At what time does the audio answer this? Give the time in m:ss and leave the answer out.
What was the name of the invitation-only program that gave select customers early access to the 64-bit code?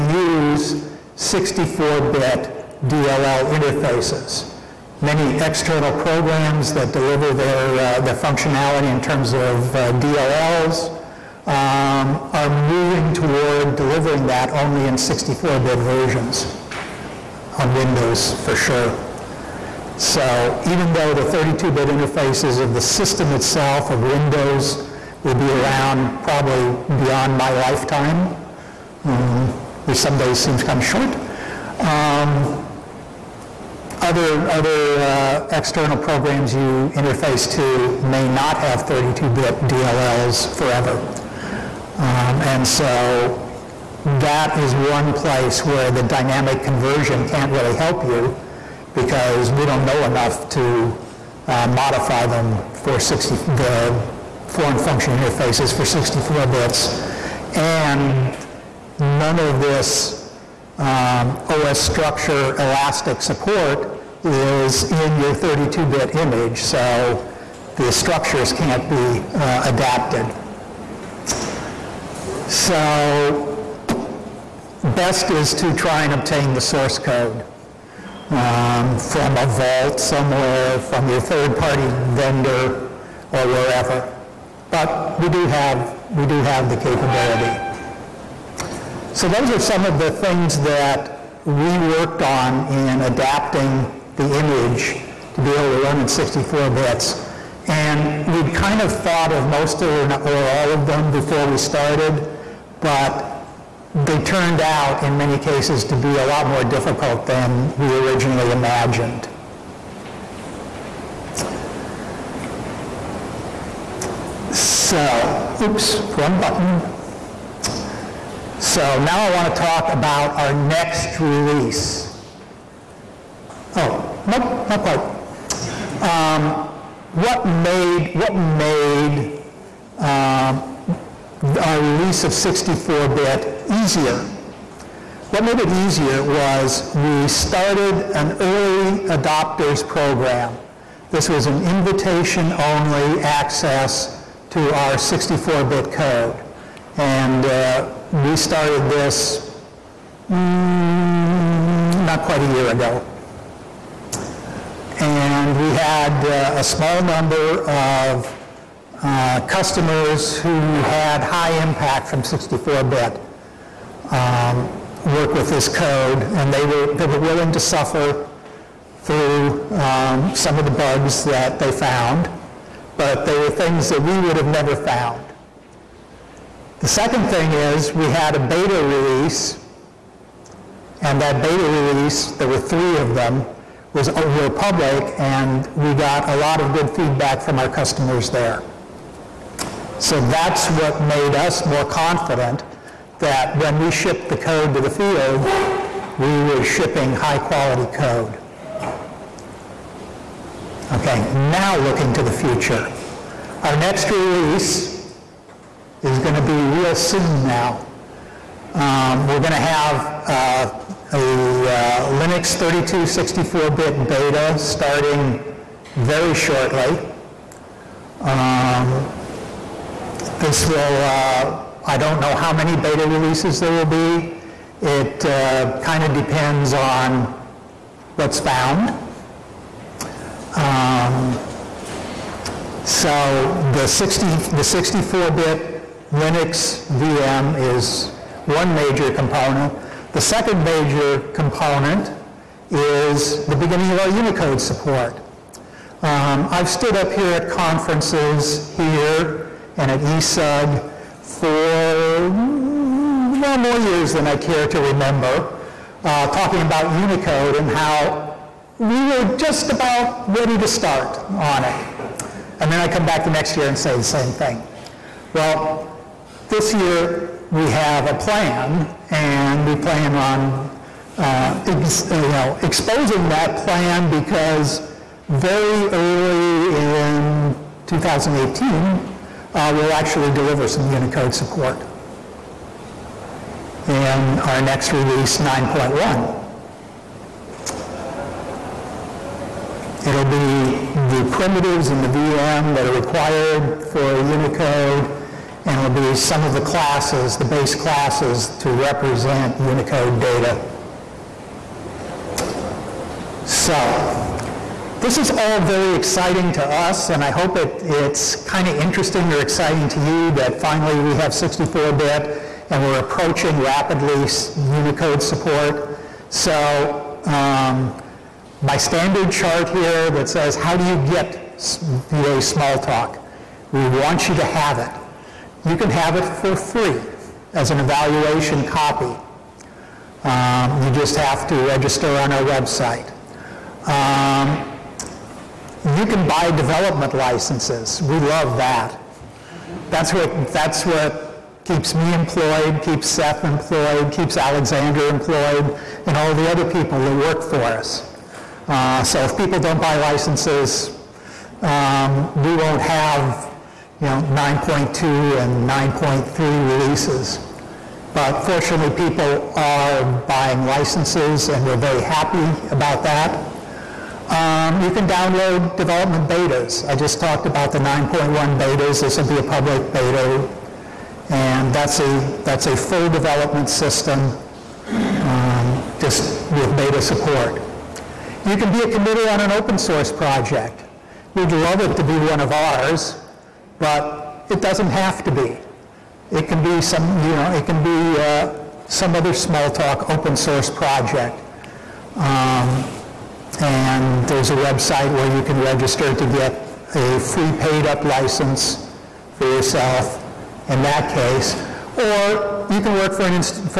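2:18.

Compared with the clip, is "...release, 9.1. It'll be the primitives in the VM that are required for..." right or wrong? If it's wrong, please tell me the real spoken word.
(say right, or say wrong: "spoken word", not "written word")
right.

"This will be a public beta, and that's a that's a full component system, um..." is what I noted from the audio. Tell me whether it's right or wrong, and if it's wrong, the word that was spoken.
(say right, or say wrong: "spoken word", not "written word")
wrong: "development", not "component".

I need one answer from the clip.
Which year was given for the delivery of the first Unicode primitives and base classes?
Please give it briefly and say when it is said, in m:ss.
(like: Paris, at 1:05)
2018, at 4:37.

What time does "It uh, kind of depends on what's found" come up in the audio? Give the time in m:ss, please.
3:44.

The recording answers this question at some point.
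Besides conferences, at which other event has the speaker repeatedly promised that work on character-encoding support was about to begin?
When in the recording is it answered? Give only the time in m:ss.
4:10.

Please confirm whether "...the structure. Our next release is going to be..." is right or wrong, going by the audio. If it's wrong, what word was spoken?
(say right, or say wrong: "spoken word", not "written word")
wrong: "future", not "structure".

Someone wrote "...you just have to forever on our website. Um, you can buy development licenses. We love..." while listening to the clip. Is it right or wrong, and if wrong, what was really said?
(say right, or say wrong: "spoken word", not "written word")
wrong: "register", not "forever".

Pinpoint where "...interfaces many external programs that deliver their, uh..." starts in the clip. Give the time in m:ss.
0:03.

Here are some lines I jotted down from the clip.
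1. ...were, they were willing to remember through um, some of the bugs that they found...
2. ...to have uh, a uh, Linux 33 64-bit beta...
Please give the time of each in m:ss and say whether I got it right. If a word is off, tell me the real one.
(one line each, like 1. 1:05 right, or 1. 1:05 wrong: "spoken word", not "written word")
1. 2:46 wrong: "suffer", not "remember"
2. 3:29 wrong: "32", not "33".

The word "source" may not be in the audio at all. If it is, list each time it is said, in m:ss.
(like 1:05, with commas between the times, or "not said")
1:16, 6:19, 6:30.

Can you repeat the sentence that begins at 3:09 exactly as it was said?
So that's what made us more confident that when we shipped the code to the field, we were shipping high quality code.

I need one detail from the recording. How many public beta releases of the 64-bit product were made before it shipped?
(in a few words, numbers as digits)
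3.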